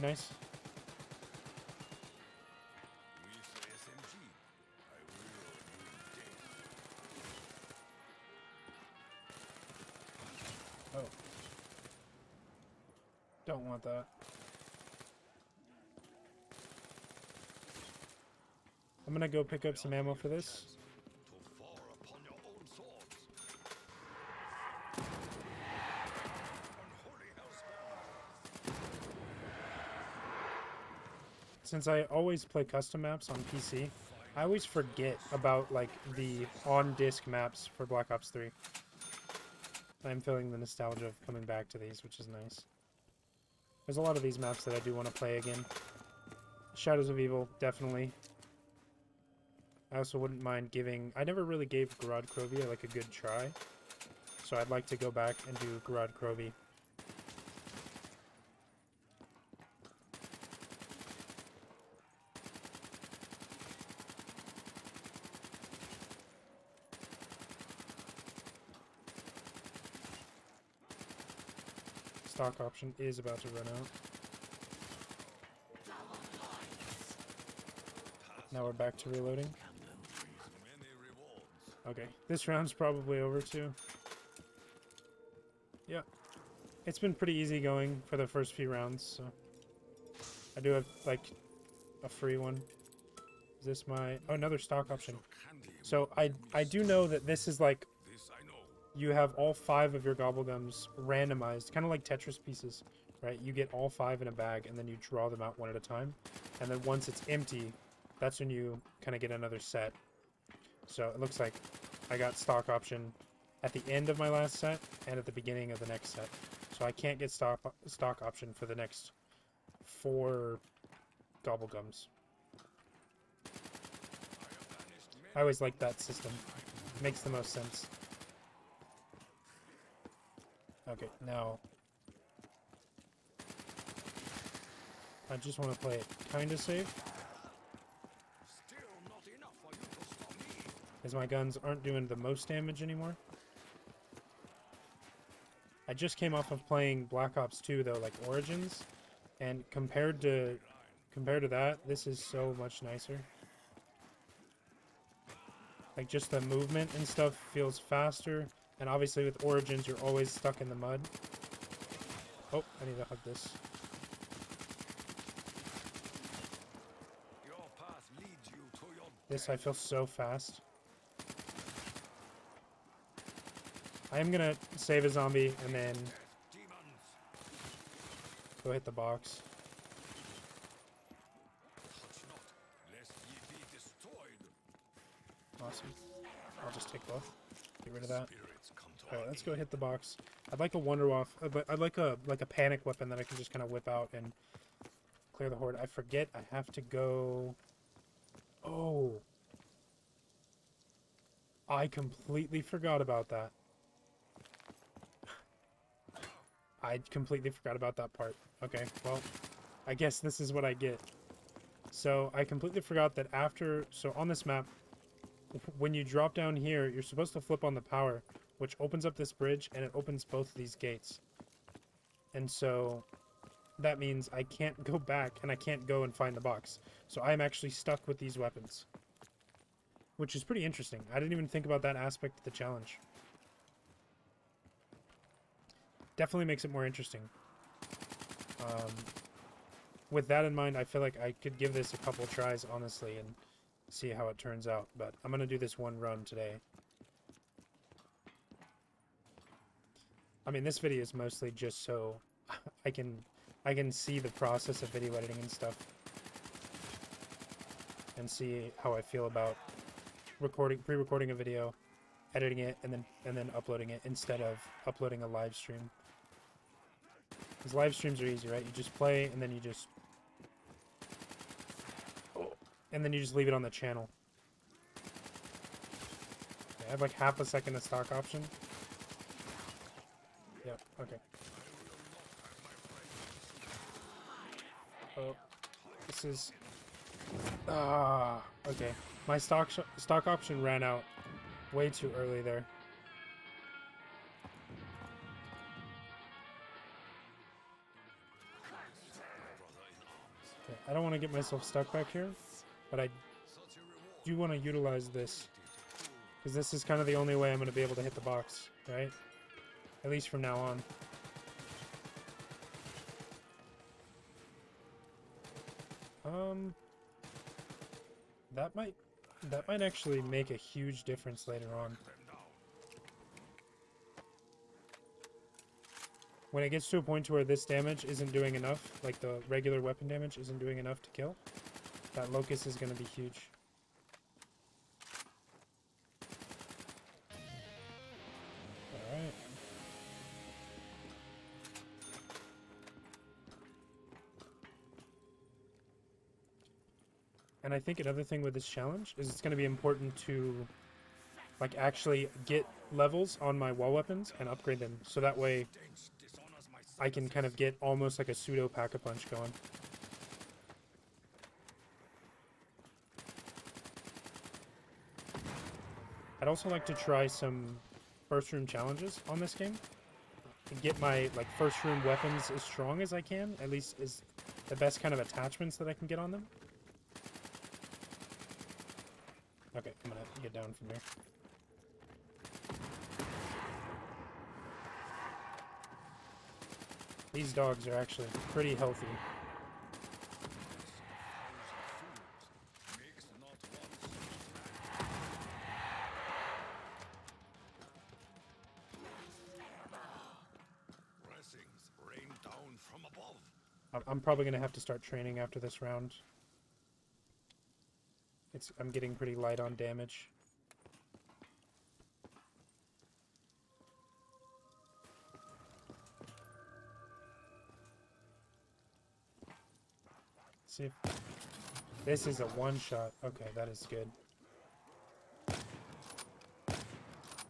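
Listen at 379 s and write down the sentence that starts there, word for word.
Okay, I'm gonna get down from here.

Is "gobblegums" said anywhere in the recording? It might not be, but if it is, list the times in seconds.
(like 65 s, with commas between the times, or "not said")
100 s, 121 s.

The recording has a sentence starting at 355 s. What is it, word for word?
So that way I can kind of get almost like a pseudo pack-a-punch going.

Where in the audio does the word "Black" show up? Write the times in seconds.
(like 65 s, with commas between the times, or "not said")
37 s, 147 s.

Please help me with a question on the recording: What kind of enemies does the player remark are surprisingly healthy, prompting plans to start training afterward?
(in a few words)
Dogs.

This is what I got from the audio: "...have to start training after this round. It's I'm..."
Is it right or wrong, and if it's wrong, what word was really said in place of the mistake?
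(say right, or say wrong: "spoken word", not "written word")
right.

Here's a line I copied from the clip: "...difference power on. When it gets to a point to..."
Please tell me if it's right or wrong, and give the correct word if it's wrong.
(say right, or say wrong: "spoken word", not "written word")
wrong: "later", not "power".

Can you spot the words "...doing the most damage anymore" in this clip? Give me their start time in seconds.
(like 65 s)
141 s.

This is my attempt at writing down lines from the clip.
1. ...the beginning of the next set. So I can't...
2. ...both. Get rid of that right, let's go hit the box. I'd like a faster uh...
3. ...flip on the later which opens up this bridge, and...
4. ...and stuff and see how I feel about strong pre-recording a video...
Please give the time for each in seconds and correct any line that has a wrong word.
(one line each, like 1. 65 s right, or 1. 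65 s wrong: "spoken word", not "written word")
1. 115 s right
2. 187 s wrong: "wonder", not "faster"
3. 217 s wrong: "power", not "later"
4. 255 s wrong: "recording", not "strong".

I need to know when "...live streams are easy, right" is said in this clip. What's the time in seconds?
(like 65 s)
267 s.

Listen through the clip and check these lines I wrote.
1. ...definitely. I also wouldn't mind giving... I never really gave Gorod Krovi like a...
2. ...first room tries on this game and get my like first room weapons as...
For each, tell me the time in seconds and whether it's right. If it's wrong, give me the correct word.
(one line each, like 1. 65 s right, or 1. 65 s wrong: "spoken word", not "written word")
1. 47 s right
2. 368 s wrong: "challenges", not "tries".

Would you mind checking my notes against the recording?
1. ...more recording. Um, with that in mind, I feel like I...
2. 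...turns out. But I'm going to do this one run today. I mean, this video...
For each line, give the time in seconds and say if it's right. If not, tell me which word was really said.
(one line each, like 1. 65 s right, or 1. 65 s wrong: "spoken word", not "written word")
1. 236 s wrong: "interesting", not "recording"
2. 244 s right.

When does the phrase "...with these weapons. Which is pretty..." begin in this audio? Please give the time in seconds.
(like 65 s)
228 s.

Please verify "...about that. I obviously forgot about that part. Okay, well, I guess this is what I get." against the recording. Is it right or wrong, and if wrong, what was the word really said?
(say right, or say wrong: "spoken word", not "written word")
wrong: "completely", not "obviously".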